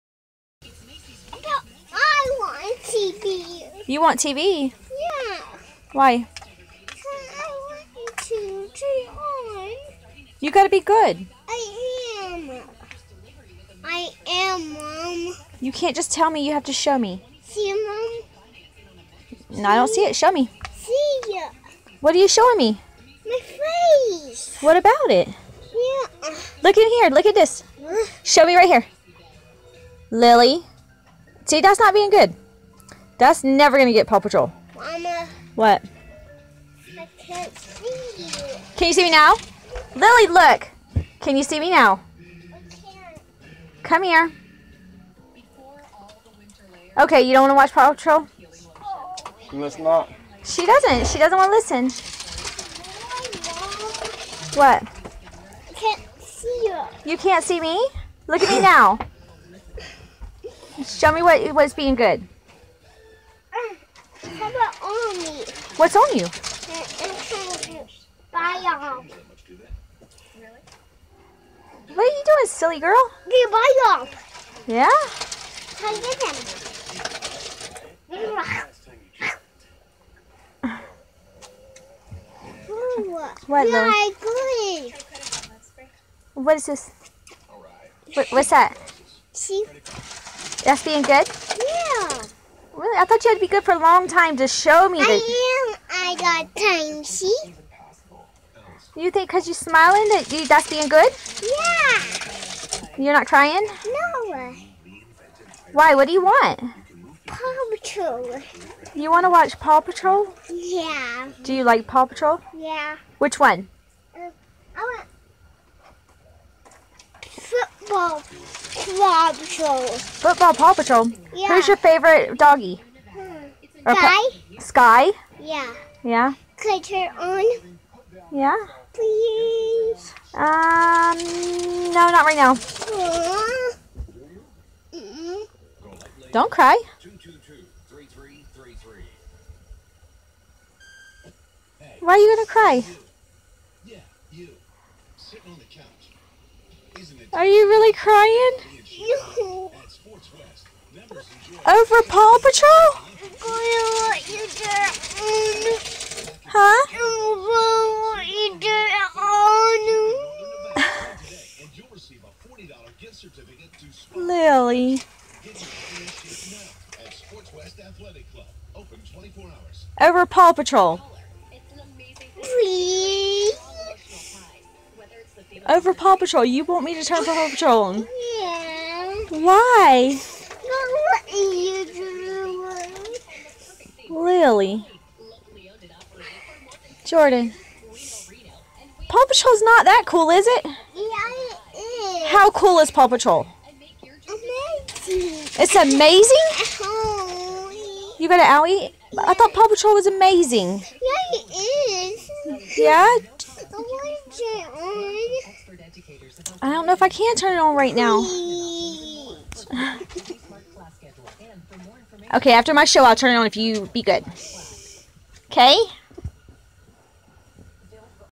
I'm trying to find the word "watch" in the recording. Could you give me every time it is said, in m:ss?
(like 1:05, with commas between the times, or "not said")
0:47, 1:49.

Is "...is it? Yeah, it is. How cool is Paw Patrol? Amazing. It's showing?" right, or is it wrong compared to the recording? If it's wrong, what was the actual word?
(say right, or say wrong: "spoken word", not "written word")
wrong: "amazing", not "showing".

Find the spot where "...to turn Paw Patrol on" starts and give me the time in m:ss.
2:56.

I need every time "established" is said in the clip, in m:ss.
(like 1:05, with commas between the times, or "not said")
not said.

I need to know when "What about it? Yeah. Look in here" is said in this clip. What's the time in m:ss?
0:24.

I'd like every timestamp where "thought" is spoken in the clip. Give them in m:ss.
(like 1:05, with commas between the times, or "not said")
1:33, 3:19.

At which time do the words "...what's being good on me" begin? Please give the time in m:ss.
1:01.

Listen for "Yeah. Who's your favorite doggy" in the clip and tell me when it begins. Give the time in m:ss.
2:01.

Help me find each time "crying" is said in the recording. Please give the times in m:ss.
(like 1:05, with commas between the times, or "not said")
1:43.